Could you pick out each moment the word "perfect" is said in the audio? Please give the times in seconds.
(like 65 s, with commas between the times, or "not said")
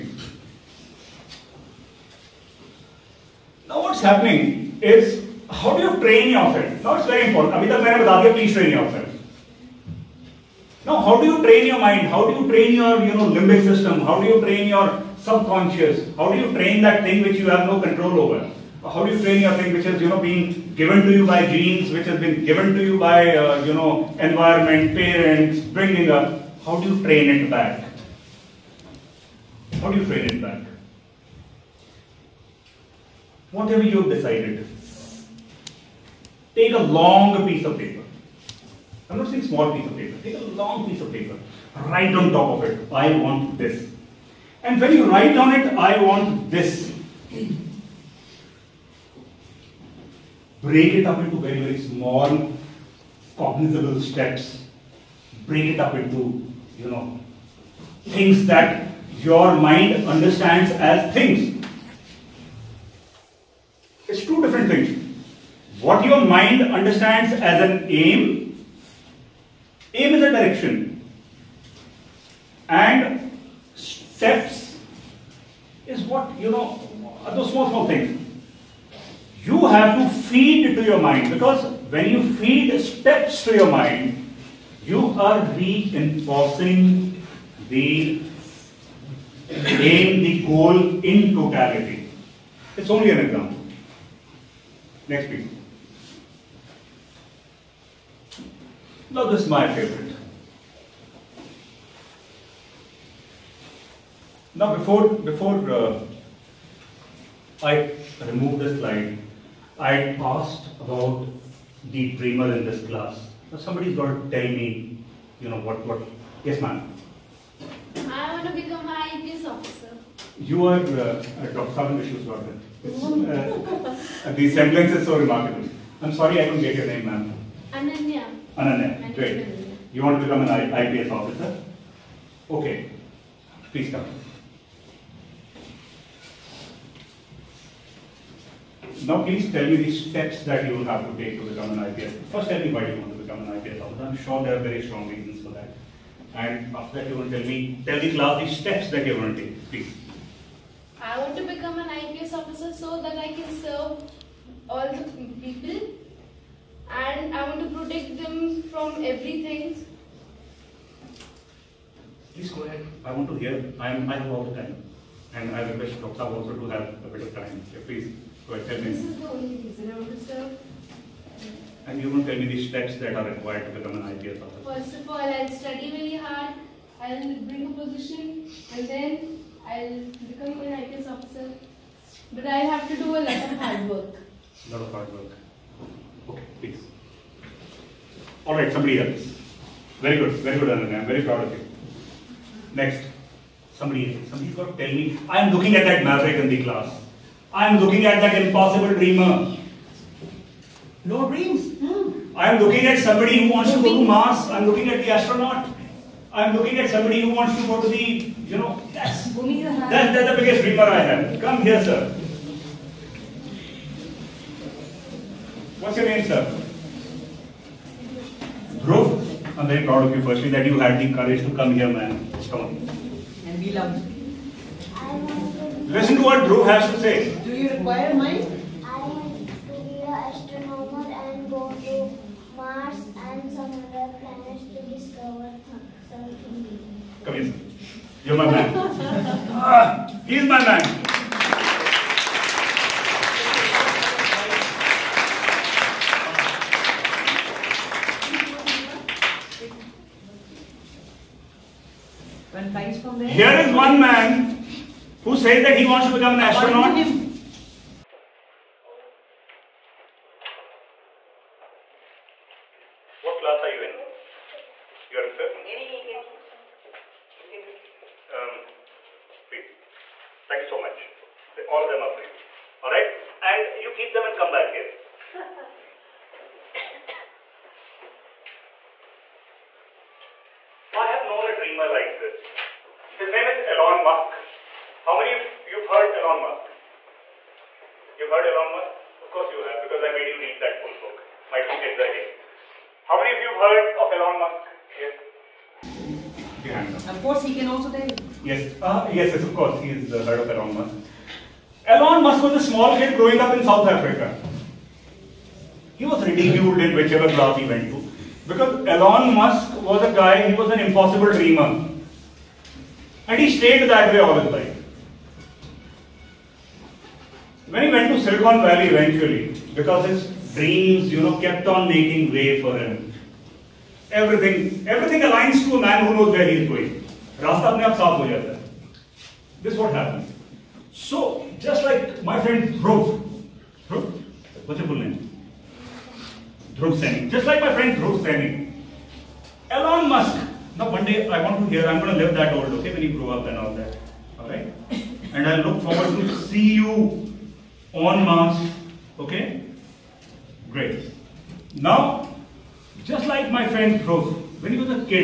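not said.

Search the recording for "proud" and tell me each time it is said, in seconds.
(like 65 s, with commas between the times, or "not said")
191 s, 219 s.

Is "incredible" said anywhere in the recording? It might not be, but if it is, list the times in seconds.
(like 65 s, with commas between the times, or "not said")
not said.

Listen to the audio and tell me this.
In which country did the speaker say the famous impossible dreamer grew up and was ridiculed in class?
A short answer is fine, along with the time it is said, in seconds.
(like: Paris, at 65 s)
South Africa, at 303 s.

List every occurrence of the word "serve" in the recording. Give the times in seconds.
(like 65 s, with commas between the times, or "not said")
153 s, 170 s.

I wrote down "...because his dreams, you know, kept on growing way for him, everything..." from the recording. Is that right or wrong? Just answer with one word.
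wrong.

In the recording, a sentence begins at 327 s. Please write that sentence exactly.
रास्ता अपने आप साफ हो जाता This is what happened.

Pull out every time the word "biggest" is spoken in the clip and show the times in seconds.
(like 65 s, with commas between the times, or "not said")
210 s.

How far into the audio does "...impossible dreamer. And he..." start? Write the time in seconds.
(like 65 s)
310 s.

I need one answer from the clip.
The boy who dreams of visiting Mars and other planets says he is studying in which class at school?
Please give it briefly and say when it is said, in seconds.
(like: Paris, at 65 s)
Fifth, at 265 s.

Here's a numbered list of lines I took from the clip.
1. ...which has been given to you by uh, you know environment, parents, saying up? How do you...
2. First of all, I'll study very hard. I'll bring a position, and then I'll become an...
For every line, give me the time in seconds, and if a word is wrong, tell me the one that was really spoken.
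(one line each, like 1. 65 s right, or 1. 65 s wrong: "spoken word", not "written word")
1. 21 s wrong: "bringing", not "saying"
2. 174 s right.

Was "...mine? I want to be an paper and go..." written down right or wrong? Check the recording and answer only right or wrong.
wrong.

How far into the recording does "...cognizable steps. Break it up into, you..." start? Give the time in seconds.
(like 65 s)
53 s.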